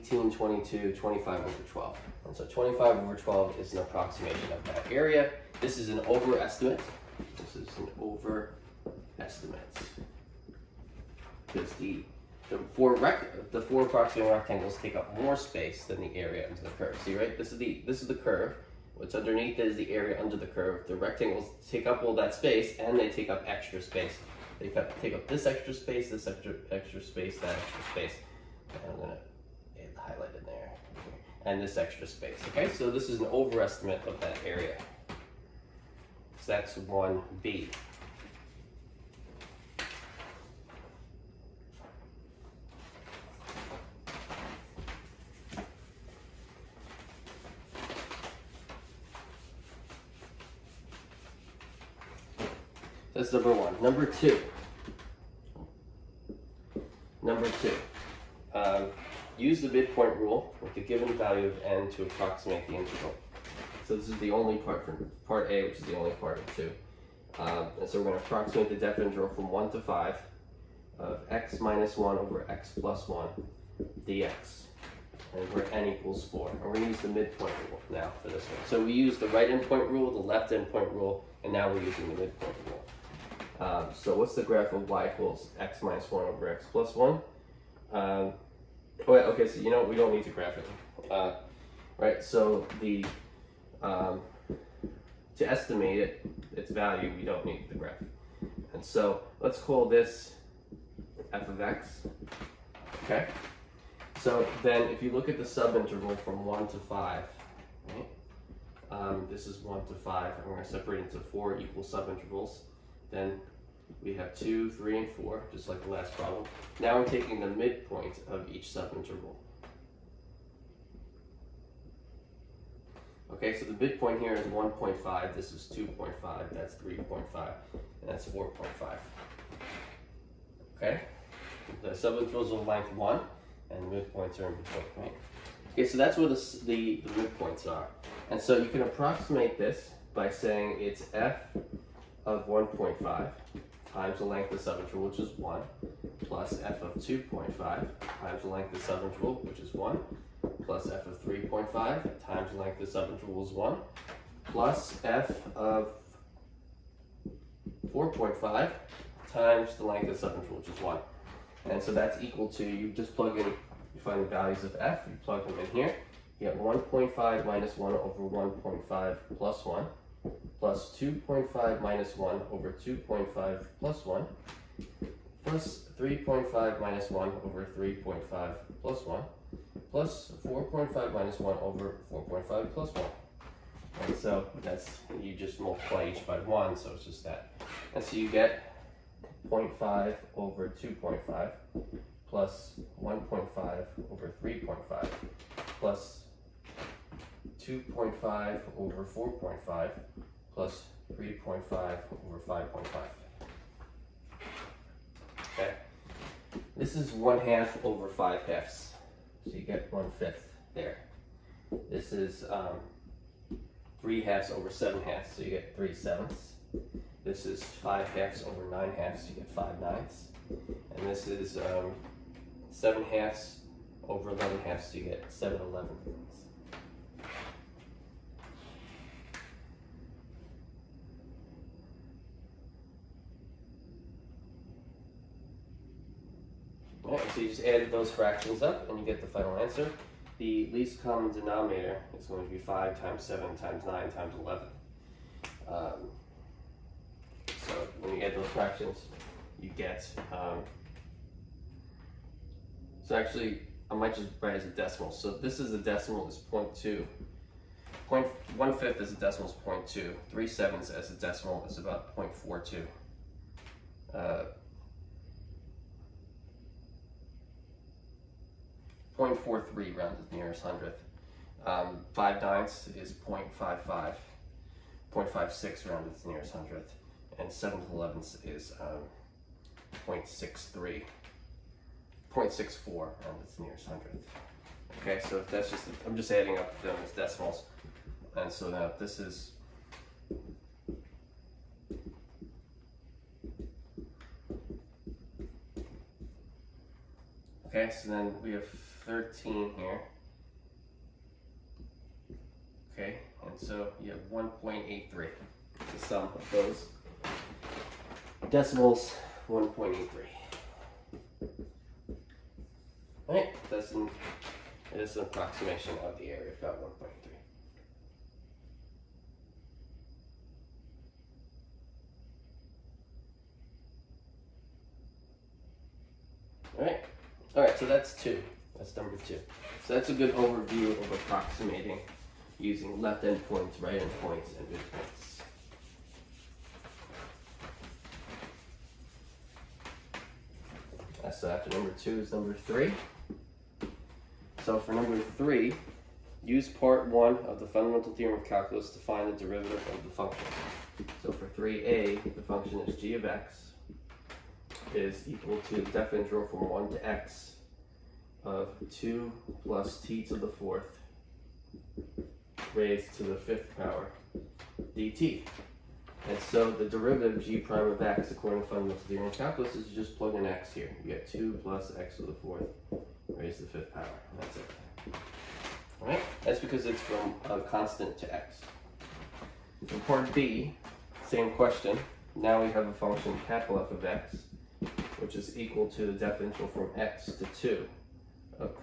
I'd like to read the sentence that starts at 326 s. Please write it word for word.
All right, all right, so that's two.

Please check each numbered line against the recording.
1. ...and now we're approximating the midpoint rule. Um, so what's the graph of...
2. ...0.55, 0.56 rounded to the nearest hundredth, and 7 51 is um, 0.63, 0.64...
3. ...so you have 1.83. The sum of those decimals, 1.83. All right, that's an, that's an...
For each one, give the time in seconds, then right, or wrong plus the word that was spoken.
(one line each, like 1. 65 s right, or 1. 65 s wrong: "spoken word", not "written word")
1. 81 s wrong: "using", not "approximating"
2. 273 s wrong: "11", not "51"
3. 303 s right.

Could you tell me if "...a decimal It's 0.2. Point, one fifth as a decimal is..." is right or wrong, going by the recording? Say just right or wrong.
right.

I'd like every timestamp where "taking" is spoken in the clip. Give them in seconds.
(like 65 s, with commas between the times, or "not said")
117 s.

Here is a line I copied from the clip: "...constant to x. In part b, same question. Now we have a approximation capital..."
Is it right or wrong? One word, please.
wrong.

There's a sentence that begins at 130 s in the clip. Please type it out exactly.
Okay, the subintervals of length 1, and the midpoints are in between, right?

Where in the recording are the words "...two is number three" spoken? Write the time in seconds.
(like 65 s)
341 s.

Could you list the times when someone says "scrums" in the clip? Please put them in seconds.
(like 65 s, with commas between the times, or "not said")
not said.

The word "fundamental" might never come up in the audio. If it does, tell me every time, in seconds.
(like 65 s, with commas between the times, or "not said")
347 s, 368 s.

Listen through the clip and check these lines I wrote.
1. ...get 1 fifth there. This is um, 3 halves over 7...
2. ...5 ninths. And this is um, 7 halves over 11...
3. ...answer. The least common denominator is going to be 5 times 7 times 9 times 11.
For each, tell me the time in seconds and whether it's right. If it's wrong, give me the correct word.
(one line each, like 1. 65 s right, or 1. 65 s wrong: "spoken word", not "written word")
1. 209 s right
2. 219 s right
3. 239 s right.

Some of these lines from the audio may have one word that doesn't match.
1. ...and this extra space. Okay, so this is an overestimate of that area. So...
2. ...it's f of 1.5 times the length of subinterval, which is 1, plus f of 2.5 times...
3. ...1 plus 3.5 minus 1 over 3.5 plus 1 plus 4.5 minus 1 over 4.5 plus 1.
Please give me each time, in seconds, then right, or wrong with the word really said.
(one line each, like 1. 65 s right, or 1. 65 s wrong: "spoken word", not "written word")
1. 31 s right
2. 140 s right
3. 174 s right.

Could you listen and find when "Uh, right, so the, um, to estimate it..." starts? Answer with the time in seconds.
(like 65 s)
91 s.